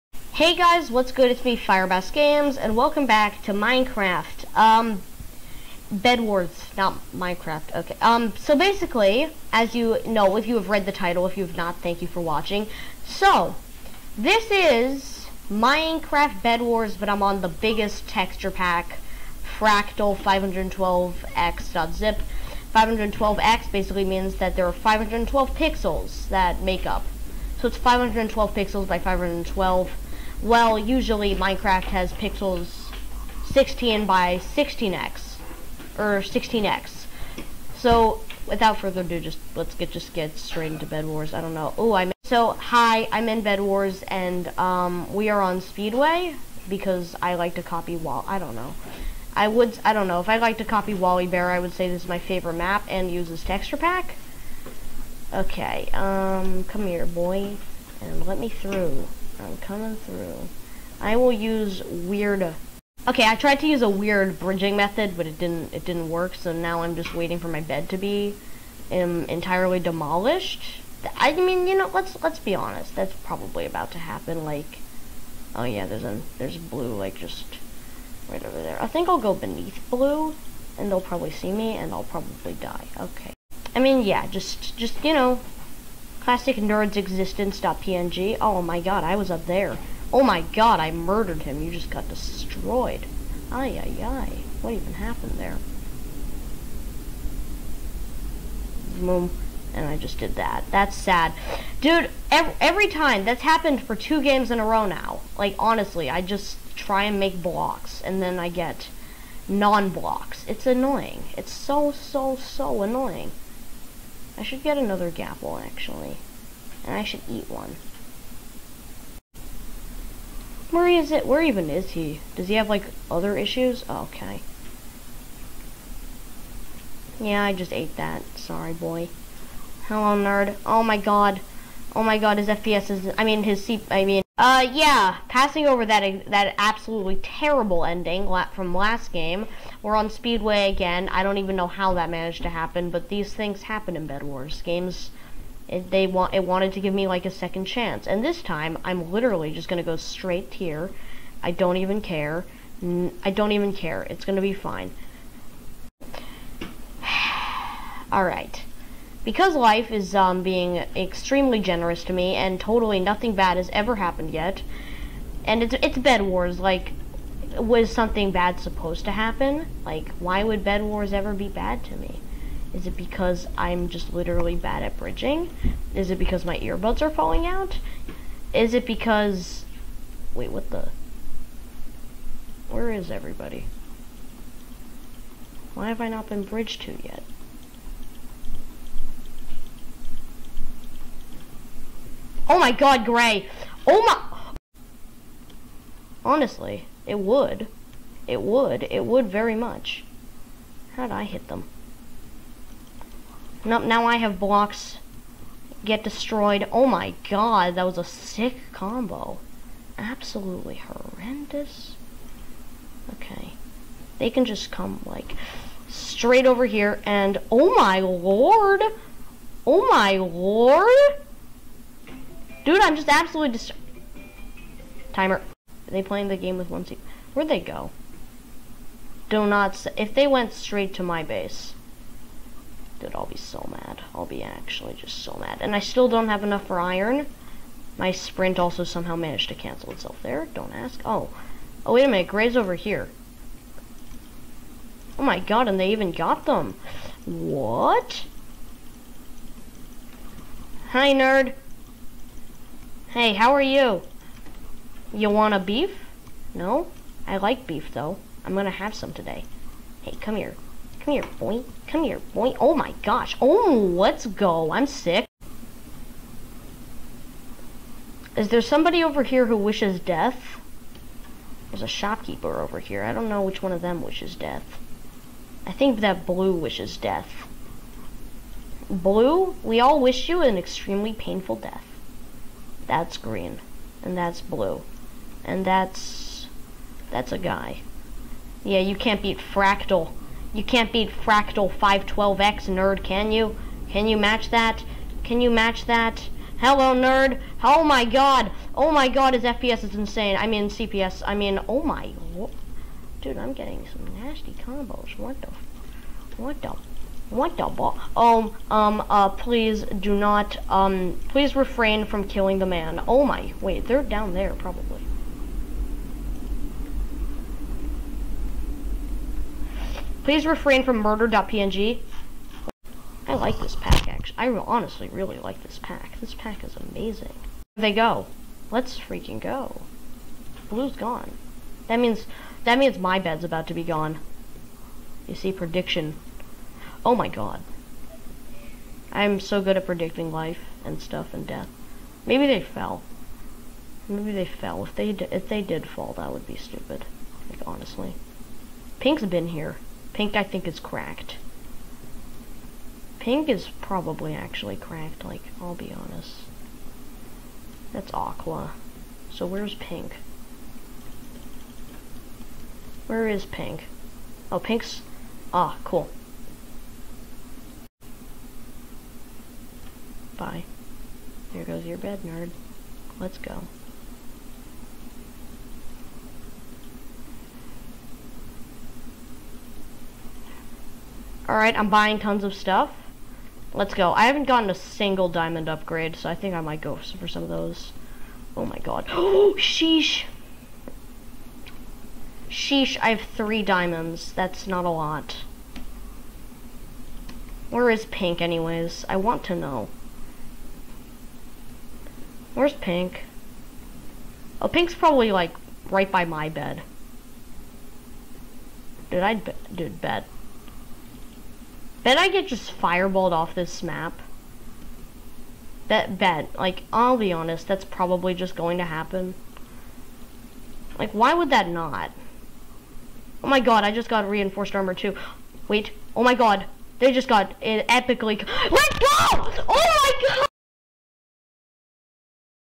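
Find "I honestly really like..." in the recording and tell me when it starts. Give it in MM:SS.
05:24.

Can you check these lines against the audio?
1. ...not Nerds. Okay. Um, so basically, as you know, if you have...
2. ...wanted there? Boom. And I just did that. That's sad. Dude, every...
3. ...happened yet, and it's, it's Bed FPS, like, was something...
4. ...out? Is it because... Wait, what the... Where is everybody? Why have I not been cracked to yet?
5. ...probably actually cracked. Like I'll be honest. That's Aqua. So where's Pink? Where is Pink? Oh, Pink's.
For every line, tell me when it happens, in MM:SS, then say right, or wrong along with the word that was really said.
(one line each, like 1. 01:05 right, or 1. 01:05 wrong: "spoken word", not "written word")
1. 00:06 wrong: "Minecraft", not "Nerds"
2. 01:34 wrong: "happened", not "wanted"
3. 02:43 wrong: "Wars", not "FPS"
4. 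02:57 wrong: "bridged", not "cracked"
5. 05:53 right.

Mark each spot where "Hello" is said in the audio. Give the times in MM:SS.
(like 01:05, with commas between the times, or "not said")
02:09, 04:56.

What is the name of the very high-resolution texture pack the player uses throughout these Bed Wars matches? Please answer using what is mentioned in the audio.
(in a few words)
Fractal 512x.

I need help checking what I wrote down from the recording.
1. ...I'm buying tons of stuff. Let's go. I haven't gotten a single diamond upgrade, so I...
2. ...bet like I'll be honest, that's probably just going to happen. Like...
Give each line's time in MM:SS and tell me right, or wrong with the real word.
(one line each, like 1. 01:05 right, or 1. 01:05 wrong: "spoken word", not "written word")
1. 06:21 right
2. 06:56 right.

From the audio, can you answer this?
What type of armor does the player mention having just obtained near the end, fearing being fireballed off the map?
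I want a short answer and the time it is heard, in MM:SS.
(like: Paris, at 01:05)
Reinforced armor, at 07:04.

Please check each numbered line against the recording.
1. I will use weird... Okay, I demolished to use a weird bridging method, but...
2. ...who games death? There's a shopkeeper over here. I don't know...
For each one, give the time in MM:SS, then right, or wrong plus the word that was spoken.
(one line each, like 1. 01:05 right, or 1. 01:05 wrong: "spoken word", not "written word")
1. 01:00 wrong: "tried", not "demolished"
2. 04:29 wrong: "wishes", not "games".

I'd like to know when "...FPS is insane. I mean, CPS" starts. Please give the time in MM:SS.
04:59.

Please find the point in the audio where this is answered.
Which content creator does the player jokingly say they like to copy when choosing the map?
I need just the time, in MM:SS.
00:50.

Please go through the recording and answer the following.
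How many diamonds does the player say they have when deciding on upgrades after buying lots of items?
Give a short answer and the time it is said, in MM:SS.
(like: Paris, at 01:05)
3, at 06:33.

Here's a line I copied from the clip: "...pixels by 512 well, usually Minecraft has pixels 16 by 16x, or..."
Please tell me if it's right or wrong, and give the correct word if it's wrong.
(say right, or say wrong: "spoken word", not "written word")
right.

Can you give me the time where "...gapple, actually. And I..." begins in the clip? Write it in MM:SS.
01:55.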